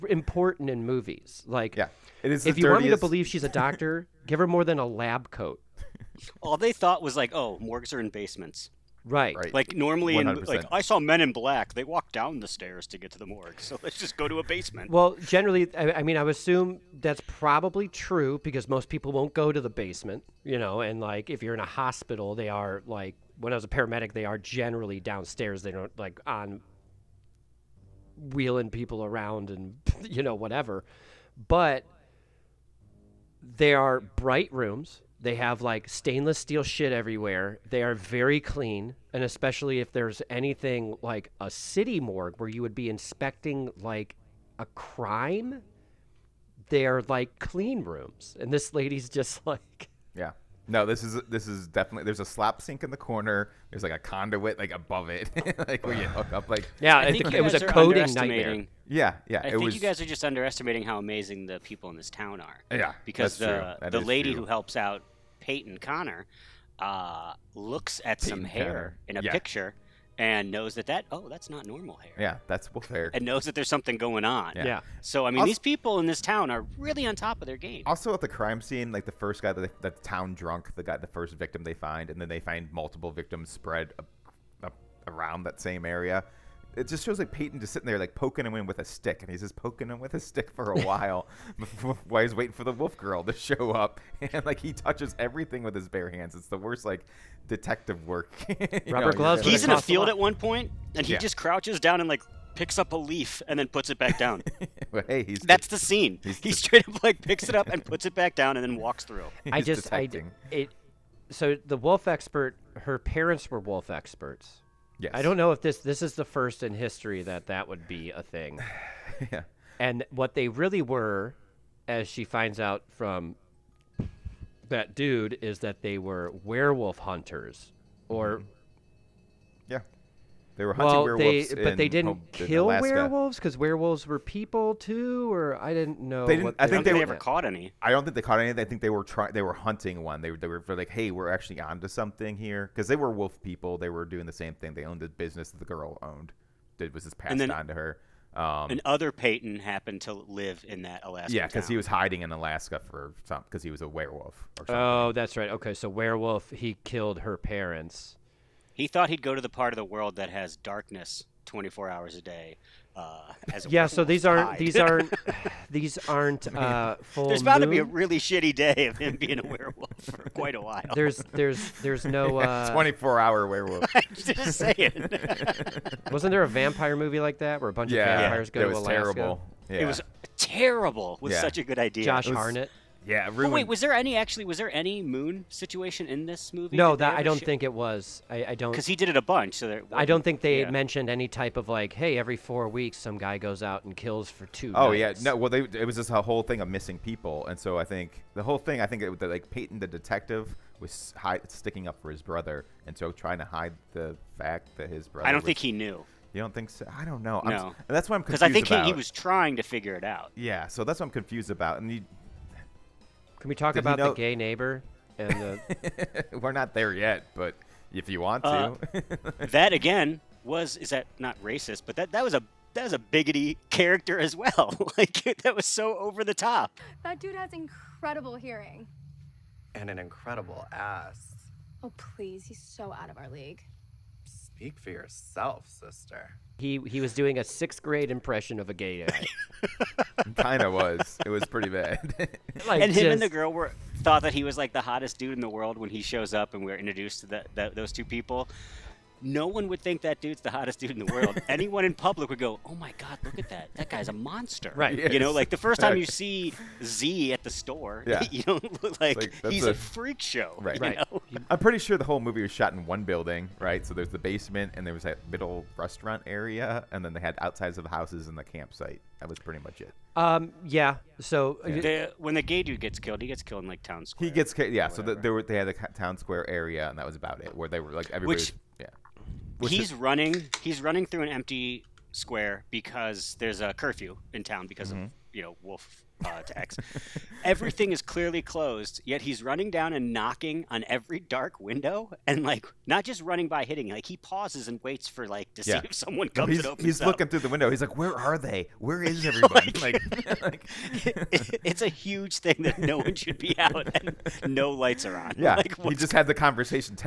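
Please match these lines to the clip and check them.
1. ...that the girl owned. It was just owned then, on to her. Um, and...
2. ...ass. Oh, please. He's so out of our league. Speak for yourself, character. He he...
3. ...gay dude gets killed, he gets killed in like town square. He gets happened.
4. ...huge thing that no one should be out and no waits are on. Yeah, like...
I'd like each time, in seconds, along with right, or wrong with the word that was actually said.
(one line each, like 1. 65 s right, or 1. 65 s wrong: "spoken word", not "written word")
1. 145 s wrong: "passed", not "owned"
2. 230 s wrong: "sister", not "character"
3. 272 s wrong: "killed", not "happened"
4. 301 s wrong: "lights", not "waits".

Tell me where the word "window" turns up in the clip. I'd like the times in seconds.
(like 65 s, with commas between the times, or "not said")
291 s, 297 s.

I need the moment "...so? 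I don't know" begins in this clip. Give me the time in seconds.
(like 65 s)
206 s.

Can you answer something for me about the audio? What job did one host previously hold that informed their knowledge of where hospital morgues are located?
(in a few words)
paramedic.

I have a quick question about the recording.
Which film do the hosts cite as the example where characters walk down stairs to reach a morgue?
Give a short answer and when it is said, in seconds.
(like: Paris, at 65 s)
Men in Black, at 10 s.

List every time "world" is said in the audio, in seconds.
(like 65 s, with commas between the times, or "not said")
159 s, 245 s, 251 s.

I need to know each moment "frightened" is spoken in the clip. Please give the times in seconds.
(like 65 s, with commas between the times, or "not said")
not said.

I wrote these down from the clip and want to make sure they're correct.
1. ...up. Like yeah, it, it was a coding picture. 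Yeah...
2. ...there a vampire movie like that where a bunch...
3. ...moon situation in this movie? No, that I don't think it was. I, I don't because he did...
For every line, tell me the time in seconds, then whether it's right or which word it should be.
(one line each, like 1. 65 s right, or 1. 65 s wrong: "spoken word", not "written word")
1. 56 s wrong: "nightmare", not "picture"
2. 176 s right
3. 185 s right.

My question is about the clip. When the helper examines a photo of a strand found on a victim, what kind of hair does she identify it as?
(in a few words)
wolf hair.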